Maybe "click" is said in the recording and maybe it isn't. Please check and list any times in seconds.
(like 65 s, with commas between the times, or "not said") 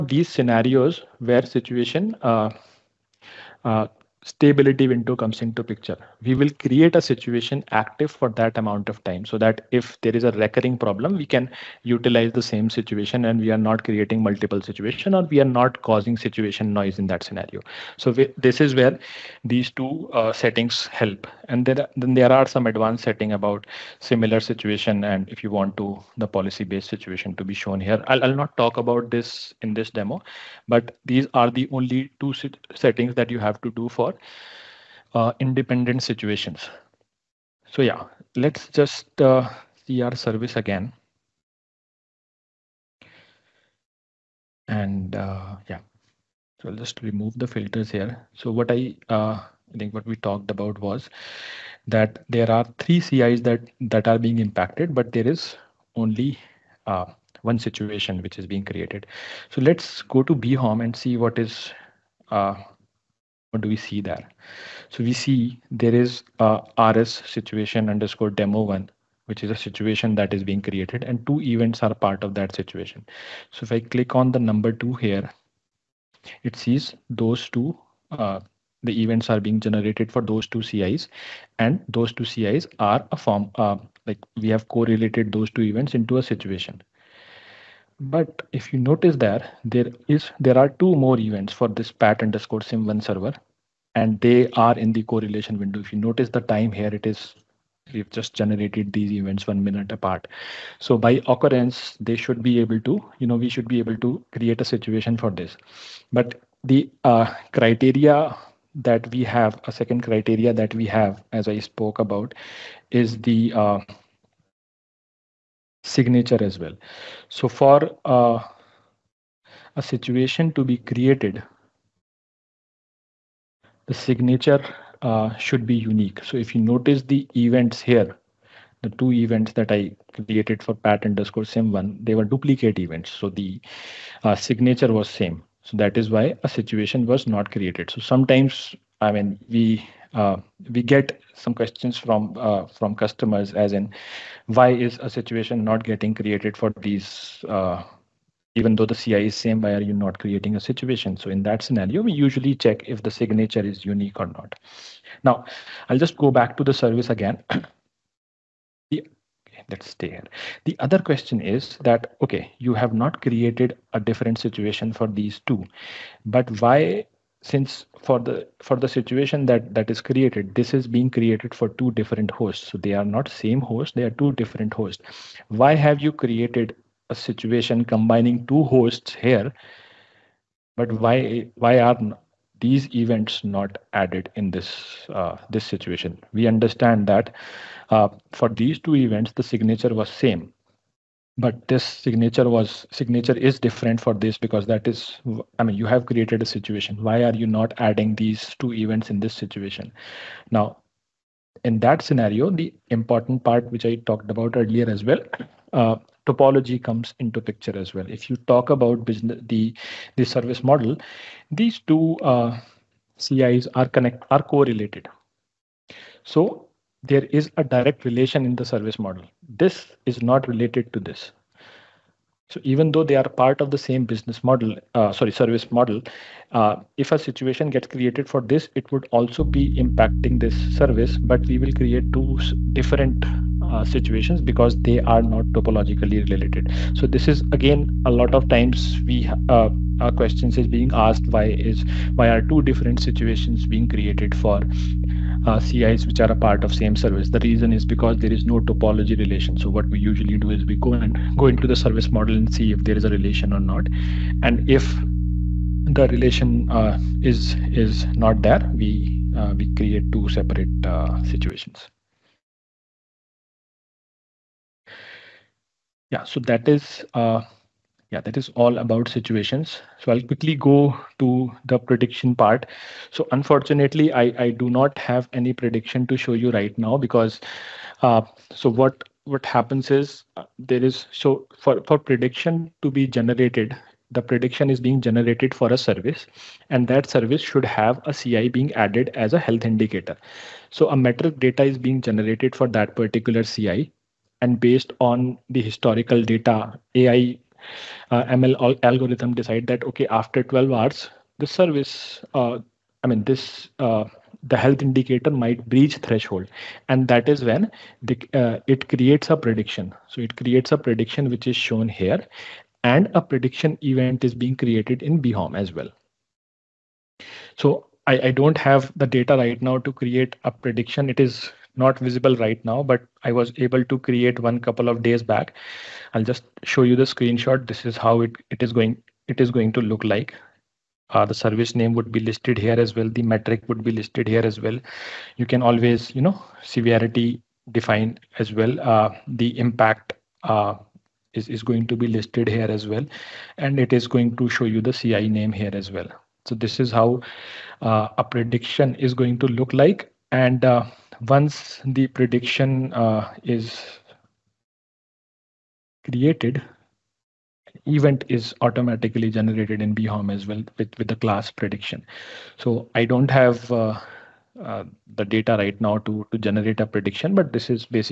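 73 s.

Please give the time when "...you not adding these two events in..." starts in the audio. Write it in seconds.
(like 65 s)
197 s.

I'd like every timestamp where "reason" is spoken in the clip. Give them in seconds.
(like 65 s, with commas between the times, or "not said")
247 s.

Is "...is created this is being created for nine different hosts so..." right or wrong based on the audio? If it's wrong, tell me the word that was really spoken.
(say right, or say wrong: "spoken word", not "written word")
wrong: "two", not "nine".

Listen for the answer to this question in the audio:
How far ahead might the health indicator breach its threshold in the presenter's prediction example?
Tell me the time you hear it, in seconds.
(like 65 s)
300 s.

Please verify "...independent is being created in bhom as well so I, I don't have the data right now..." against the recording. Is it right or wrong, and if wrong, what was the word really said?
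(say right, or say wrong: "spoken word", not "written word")
wrong: "event", not "independent".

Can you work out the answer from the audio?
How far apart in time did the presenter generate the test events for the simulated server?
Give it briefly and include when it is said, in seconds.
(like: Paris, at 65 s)
1 minute, at 99 s.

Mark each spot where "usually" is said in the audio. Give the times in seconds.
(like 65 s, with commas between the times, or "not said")
152 s, 249 s.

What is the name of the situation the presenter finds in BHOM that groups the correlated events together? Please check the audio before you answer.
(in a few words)
RS situation_demo1.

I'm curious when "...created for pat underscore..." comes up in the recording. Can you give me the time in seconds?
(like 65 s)
130 s.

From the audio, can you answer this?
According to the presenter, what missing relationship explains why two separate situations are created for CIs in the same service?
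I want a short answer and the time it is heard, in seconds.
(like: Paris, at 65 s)
topology relation, at 248 s.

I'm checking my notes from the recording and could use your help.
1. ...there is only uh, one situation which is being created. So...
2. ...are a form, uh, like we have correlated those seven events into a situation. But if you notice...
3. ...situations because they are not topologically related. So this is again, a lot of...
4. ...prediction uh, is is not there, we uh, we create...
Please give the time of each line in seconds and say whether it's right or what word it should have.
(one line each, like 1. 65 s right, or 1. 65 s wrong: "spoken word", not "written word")
1. 55 s right
2. 82 s wrong: "two", not "seven"
3. 233 s right
4. 256 s wrong: "relation", not "prediction".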